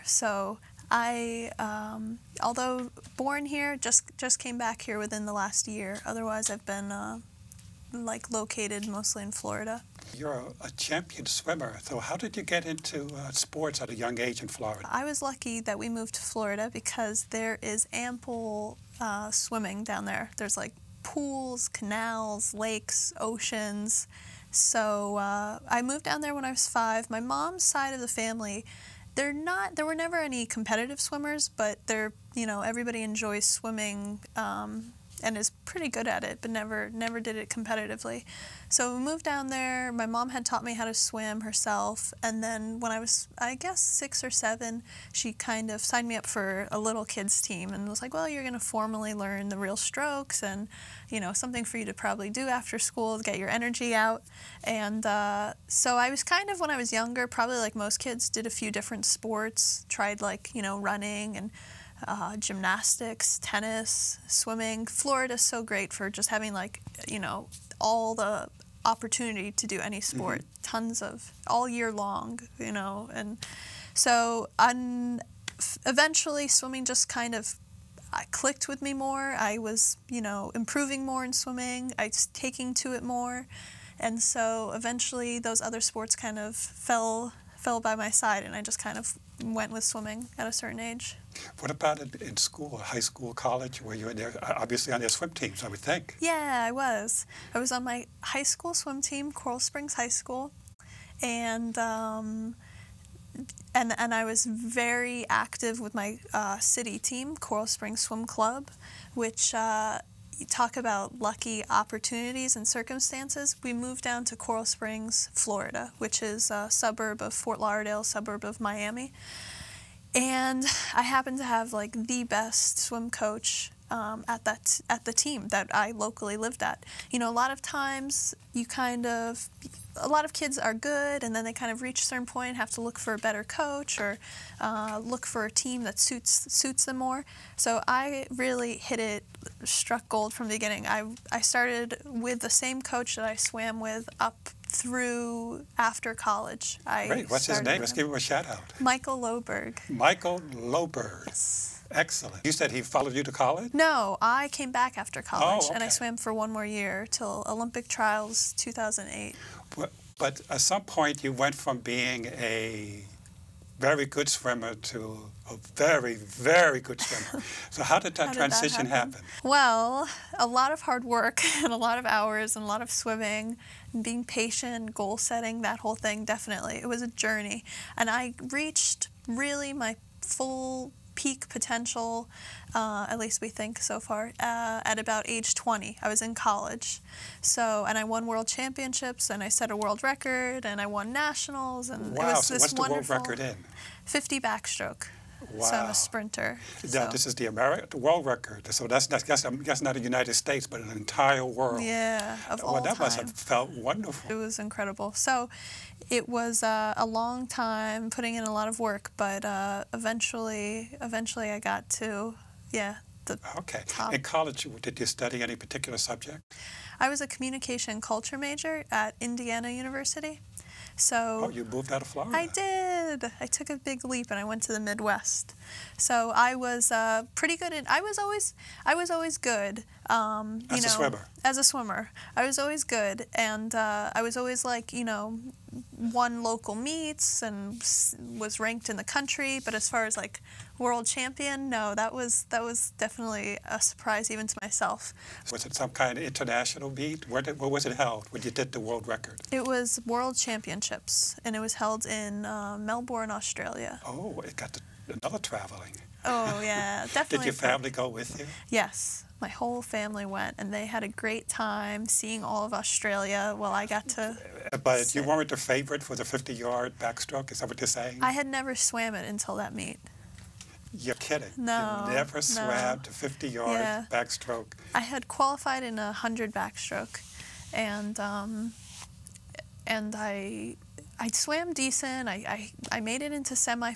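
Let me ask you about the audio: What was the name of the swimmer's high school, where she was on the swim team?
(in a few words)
Coral Springs High School.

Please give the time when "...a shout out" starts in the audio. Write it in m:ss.
2:28.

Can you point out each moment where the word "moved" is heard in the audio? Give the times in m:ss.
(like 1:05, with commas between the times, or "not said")
0:15, 0:25, 0:39, 1:53, 3:41.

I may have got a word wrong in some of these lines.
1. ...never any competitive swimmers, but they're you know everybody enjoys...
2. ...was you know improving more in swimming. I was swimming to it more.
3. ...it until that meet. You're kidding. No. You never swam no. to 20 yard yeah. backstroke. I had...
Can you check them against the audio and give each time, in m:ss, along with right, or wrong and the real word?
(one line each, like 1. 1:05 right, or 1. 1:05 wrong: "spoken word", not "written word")
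1. 0:29 right
2. 1:19 wrong: "taking", not "swimming"
3. 4:29 wrong: "50", not "20".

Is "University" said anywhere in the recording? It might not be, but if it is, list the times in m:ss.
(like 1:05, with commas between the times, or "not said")
3:39.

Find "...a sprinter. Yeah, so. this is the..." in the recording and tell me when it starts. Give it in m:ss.
3:15.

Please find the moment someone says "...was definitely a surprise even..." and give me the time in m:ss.
4:02.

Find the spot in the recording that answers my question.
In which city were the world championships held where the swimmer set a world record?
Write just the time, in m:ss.
4:12.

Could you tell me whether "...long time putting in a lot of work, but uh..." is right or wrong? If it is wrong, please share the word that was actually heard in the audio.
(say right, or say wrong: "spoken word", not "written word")
right.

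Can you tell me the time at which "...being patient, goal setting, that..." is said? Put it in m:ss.
2:54.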